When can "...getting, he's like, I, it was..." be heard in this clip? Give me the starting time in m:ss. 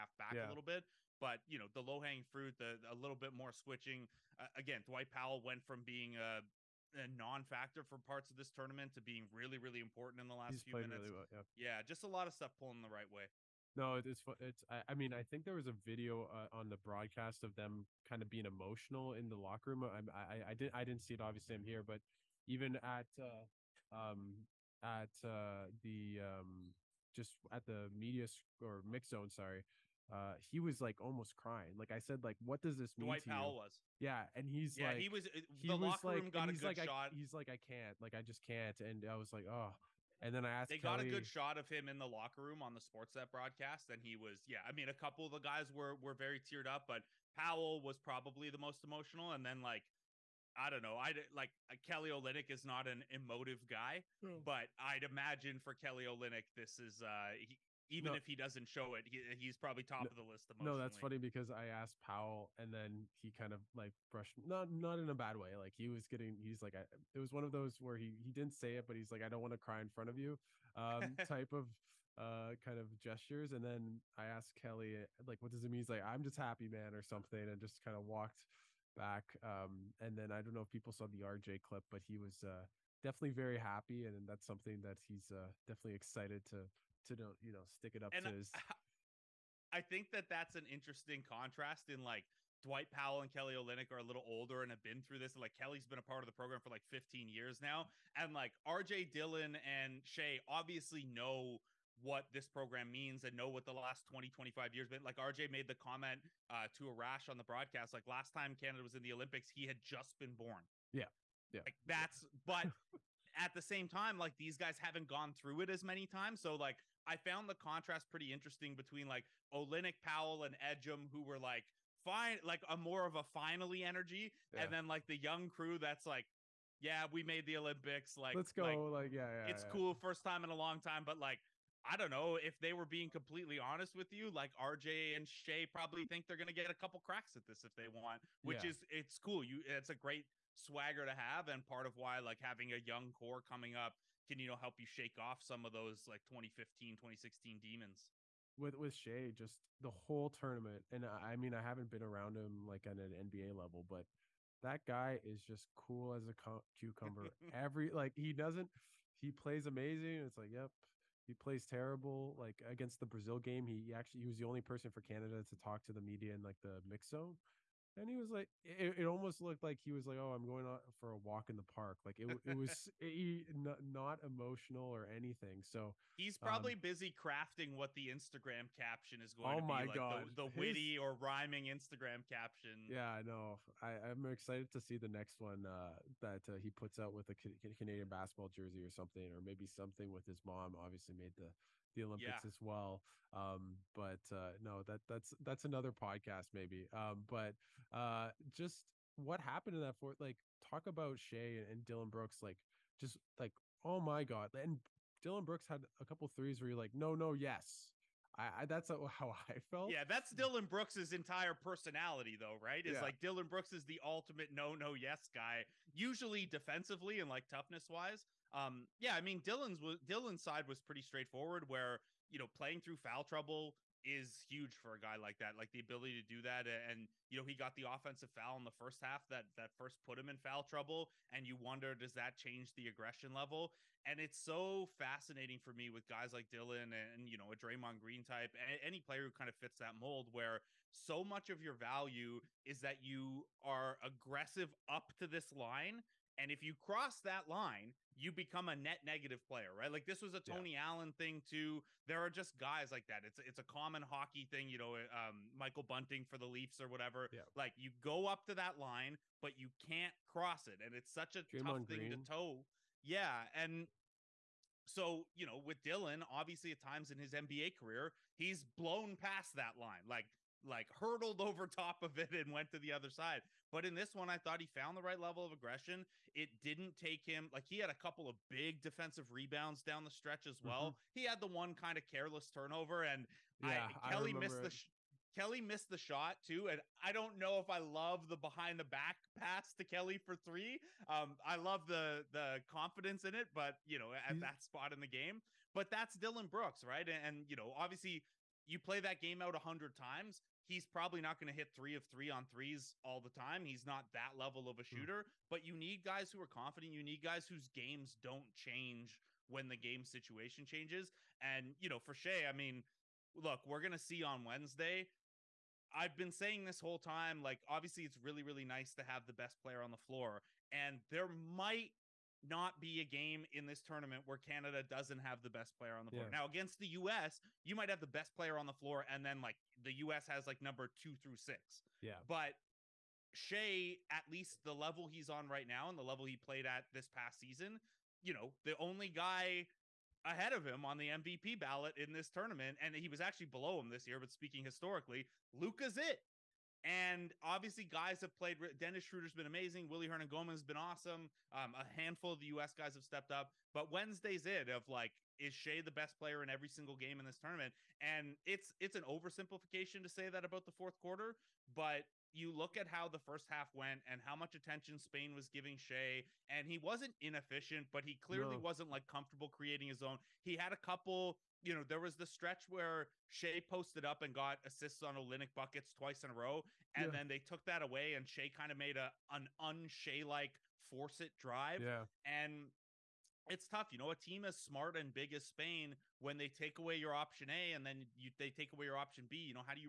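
1:06.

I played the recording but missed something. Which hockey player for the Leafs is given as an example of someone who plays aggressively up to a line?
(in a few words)
Michael Bunting.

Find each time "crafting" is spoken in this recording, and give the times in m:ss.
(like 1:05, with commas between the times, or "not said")
2:57.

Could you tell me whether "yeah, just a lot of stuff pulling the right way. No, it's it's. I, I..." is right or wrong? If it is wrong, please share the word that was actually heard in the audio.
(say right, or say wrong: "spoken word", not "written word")
right.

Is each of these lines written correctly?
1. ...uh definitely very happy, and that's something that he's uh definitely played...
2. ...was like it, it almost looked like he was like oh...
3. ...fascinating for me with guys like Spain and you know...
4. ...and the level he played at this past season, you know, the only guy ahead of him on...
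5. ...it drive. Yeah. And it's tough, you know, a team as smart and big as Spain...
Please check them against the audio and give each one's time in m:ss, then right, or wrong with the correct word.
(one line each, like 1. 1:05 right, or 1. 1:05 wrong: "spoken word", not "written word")
1. 1:22 wrong: "excited", not "played"
2. 2:48 right
3. 3:54 wrong: "Dillon", not "Spain"
4. 5:35 right
5. 6:21 right.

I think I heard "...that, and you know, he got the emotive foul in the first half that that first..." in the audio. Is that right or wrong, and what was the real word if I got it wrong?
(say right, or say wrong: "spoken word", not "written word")
wrong: "offensive", not "emotive".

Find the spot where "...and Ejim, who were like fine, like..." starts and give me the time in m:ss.
2:00.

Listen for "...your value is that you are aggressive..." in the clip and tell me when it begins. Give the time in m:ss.
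4:01.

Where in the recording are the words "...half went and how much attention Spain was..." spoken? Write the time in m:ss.
6:03.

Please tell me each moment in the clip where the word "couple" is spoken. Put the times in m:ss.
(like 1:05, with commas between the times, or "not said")
0:44, 2:16, 3:26, 4:37, 6:10.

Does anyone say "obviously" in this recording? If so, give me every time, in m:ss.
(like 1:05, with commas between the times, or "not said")
0:21, 1:40, 3:10, 4:26, 4:57, 5:17, 5:47.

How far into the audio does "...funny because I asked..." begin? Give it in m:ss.
1:00.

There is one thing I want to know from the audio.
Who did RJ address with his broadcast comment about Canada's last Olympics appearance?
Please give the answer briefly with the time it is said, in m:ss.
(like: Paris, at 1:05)
Arash, at 1:46.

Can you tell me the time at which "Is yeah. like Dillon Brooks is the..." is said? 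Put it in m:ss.
3:32.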